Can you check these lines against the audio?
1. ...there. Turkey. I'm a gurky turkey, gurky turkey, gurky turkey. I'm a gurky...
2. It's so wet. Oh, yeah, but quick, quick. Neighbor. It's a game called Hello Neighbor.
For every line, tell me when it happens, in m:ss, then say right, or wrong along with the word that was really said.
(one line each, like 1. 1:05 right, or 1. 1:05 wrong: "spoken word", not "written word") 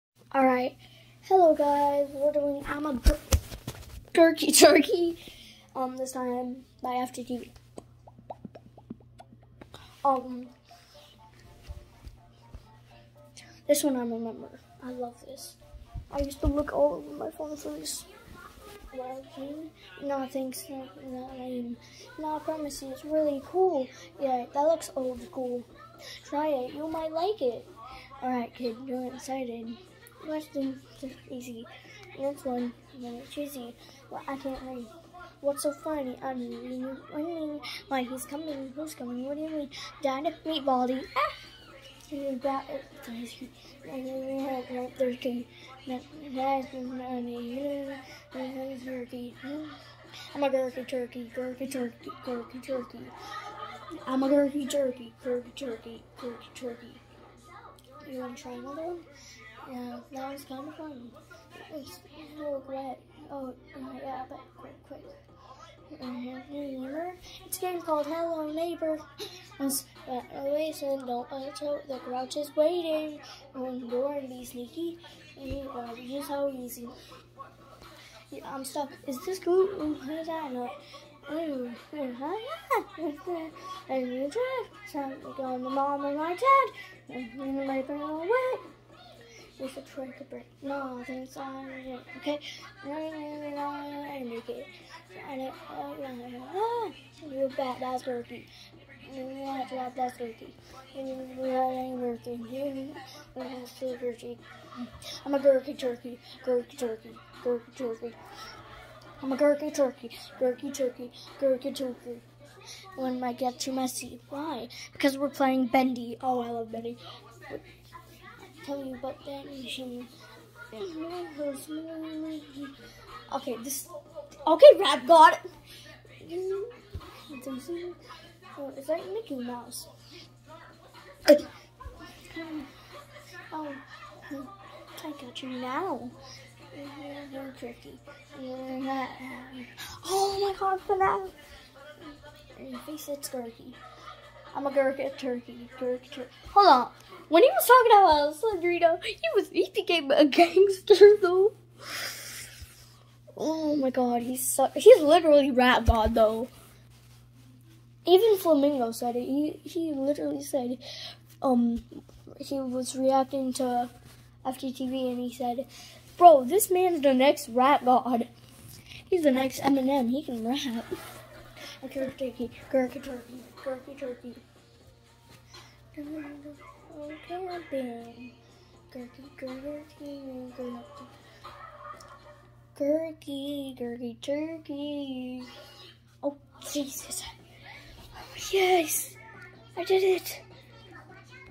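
1. 0:44 right
2. 1:01 right.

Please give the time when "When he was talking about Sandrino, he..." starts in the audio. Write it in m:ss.
2:27.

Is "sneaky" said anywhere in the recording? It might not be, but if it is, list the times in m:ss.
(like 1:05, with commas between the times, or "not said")
1:14.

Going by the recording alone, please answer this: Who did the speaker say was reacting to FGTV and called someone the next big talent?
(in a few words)
Flamingo.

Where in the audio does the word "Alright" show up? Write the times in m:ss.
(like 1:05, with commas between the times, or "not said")
0:00, 0:28.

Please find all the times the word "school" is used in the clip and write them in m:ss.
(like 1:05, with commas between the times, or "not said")
0:25.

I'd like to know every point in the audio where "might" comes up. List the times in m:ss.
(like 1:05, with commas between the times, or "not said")
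0:26, 1:53.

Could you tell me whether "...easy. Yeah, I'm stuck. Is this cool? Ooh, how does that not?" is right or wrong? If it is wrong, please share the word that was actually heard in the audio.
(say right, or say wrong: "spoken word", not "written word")
right.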